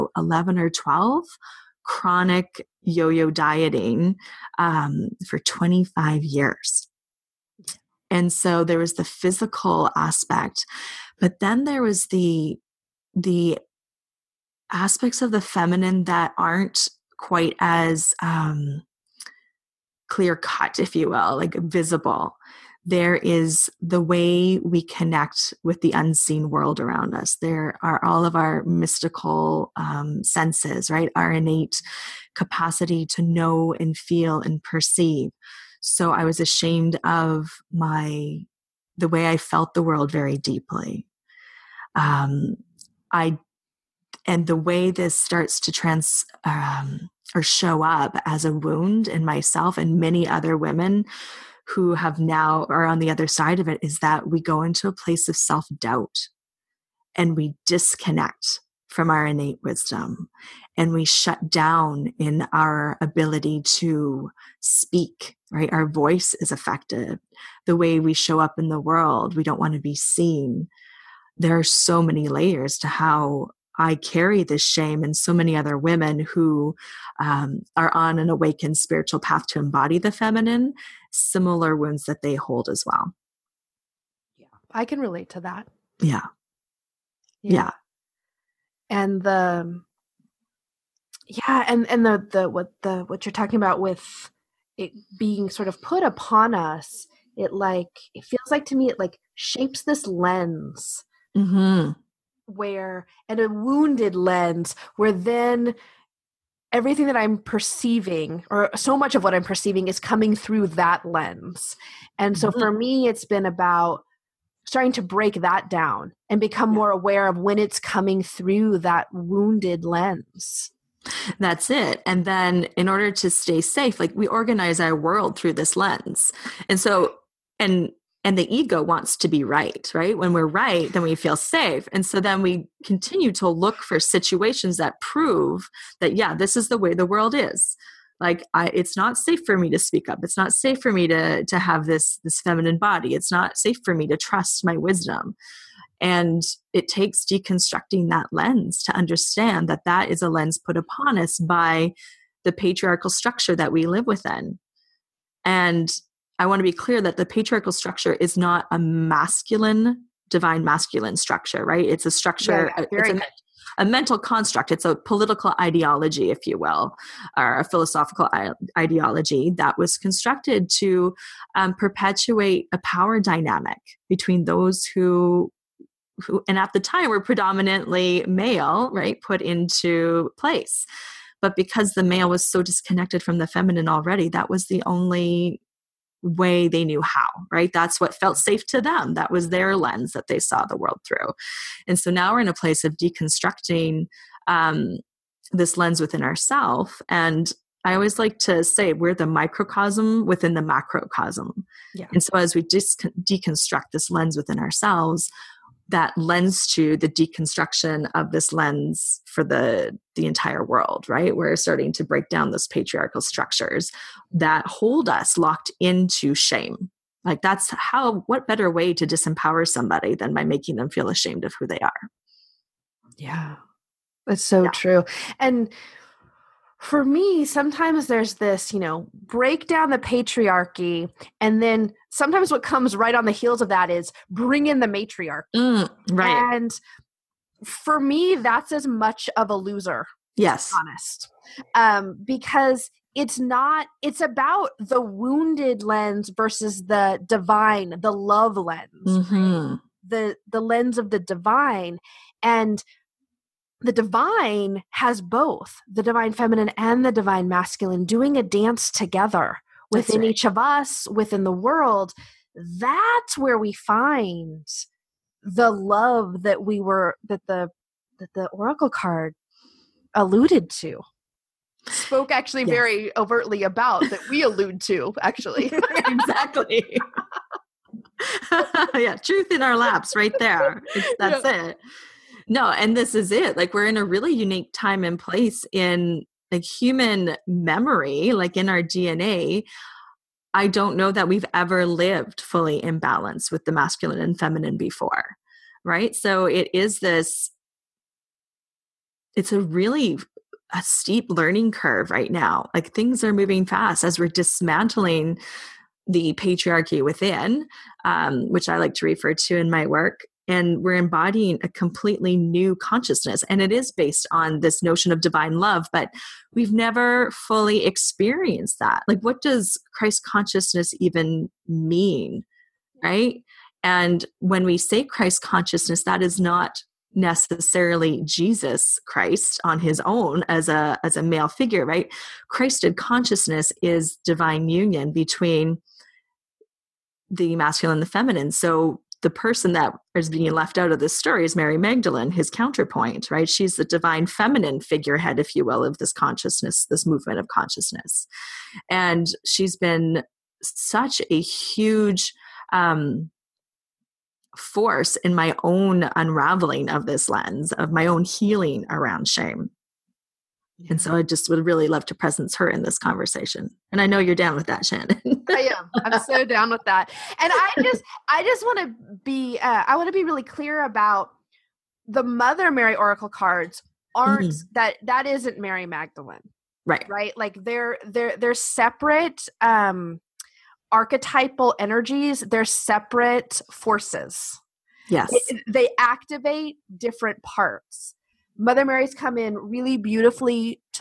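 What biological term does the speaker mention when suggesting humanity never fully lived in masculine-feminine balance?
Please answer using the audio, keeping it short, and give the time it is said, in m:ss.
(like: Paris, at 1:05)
DNA, at 4:48.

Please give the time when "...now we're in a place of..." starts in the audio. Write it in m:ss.
3:12.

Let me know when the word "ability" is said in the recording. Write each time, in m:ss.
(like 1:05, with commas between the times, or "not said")
1:03.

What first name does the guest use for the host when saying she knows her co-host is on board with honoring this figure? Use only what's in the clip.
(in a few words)
Shannon.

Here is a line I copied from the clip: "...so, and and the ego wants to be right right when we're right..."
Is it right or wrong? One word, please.
right.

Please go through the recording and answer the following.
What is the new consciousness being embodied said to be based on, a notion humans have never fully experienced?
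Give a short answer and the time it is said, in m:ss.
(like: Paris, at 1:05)
divine love, at 5:15.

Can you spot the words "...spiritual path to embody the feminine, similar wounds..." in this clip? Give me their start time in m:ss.
1:18.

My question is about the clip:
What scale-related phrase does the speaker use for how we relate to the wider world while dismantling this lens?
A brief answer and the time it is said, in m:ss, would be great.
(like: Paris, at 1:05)
microcosm within the macrocosm, at 3:19.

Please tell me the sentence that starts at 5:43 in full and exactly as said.
She's the divine feminine figurehead, if you will, of this consciousness, this movement of consciousness.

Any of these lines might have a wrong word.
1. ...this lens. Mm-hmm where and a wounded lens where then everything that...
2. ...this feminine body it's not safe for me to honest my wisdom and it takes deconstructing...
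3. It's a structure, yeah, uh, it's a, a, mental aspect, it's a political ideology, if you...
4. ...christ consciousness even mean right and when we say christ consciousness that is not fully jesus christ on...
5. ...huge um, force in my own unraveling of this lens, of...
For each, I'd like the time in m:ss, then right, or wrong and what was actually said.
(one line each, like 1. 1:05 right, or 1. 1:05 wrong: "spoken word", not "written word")
1. 1:39 right
2. 2:22 wrong: "trust", not "honest"
3. 2:41 wrong: "construct", not "aspect"
4. 5:19 wrong: "necessarily", not "fully"
5. 5:51 right.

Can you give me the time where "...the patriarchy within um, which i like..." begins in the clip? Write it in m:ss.
5:06.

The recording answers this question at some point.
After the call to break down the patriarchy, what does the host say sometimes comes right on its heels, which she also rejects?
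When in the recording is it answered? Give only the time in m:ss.
3:54.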